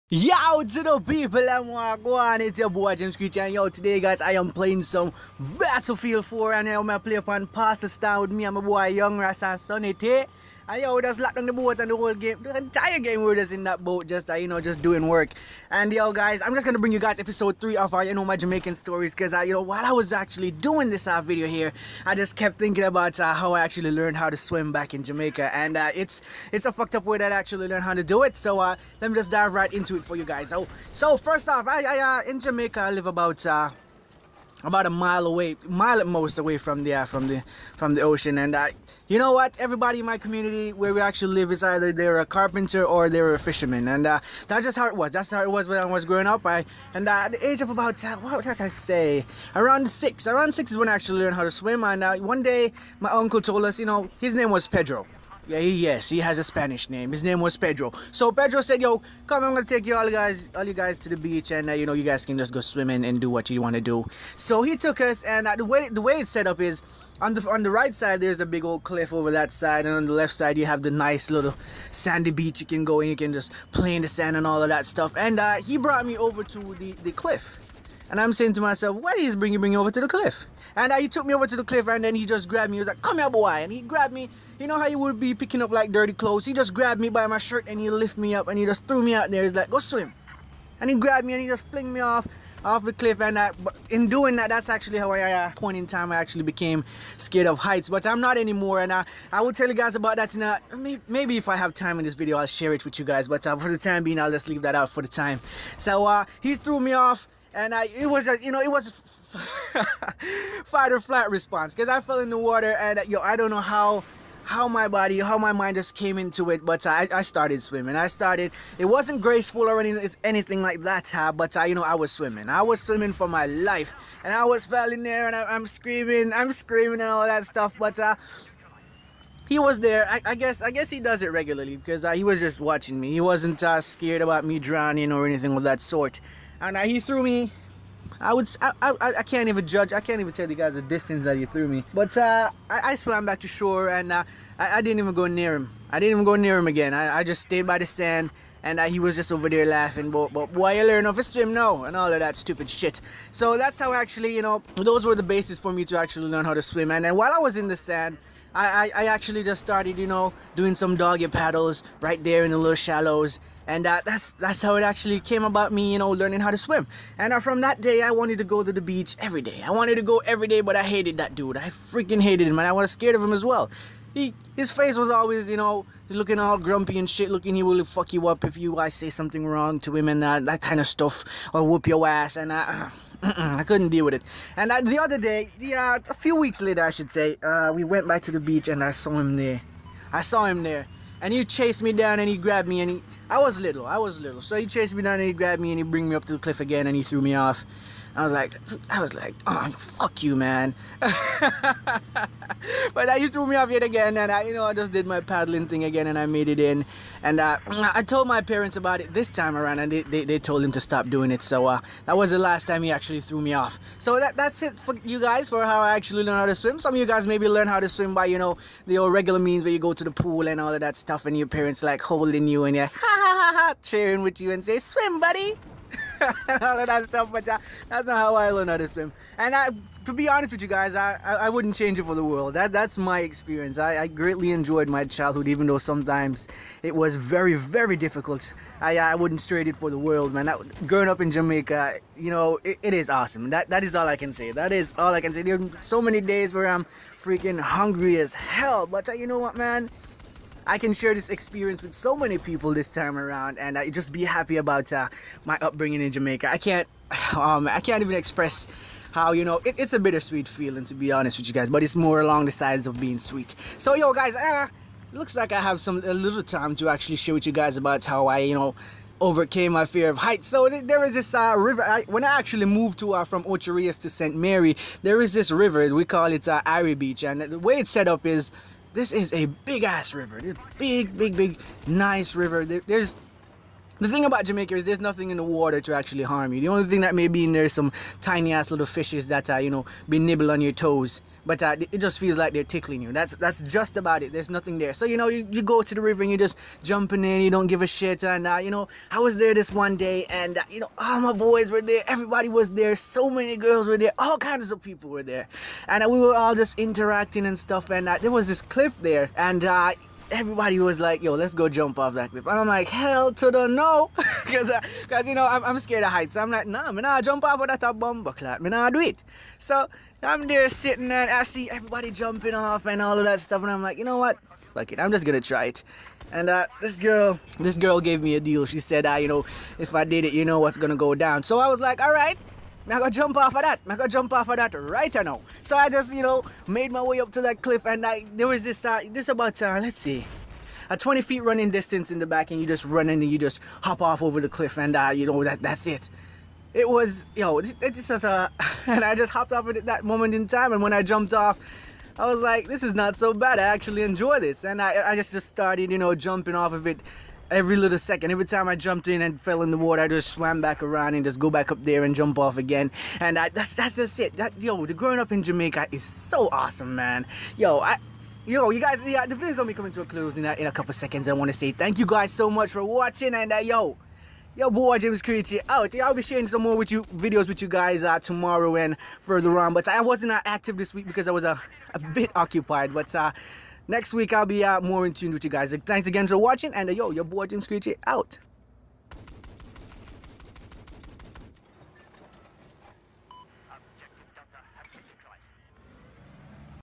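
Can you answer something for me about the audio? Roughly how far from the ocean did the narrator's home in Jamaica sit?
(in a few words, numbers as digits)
a mile.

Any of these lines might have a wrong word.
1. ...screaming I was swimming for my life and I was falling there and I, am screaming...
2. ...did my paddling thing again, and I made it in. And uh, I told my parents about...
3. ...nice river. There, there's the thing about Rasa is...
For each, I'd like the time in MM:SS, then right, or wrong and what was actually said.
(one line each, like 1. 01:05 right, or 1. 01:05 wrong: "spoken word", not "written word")
1. 02:02 wrong: "swimming", not "screaming"
2. 03:24 right
3. 04:41 wrong: "Jamaica", not "Rasa".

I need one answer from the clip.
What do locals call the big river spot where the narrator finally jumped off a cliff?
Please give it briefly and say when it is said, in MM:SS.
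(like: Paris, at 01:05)
Ari Beach, at 04:36.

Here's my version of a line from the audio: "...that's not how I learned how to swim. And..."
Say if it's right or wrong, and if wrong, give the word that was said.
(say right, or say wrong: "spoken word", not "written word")
right.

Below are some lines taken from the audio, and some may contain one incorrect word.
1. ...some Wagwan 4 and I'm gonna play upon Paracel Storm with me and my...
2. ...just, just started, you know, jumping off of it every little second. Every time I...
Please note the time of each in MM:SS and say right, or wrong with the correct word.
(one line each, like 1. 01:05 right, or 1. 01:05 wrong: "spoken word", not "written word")
1. 00:04 wrong: "Battlefield", not "Wagwan"
2. 05:55 right.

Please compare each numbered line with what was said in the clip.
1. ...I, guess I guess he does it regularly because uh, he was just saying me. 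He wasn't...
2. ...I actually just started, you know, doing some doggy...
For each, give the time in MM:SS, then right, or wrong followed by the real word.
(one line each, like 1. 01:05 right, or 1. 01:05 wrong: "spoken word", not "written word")
1. 02:10 wrong: "watching", not "saying"
2. 02:39 right.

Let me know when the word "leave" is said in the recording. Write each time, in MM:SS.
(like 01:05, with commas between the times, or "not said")
01:44.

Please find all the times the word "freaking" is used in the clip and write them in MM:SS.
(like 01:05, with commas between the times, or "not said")
02:51, 04:06.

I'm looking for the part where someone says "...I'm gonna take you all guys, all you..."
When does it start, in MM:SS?
00:59.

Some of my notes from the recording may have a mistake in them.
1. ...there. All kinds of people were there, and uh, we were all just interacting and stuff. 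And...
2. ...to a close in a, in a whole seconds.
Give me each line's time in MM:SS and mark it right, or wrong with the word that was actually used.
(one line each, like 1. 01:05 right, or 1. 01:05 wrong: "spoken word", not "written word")
1. 05:03 right
2. 06:09 wrong: "couple", not "whole".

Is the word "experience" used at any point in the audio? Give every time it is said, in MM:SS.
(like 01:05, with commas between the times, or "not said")
03:53, 04:11.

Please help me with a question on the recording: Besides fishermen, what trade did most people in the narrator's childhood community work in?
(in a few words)
carpenter.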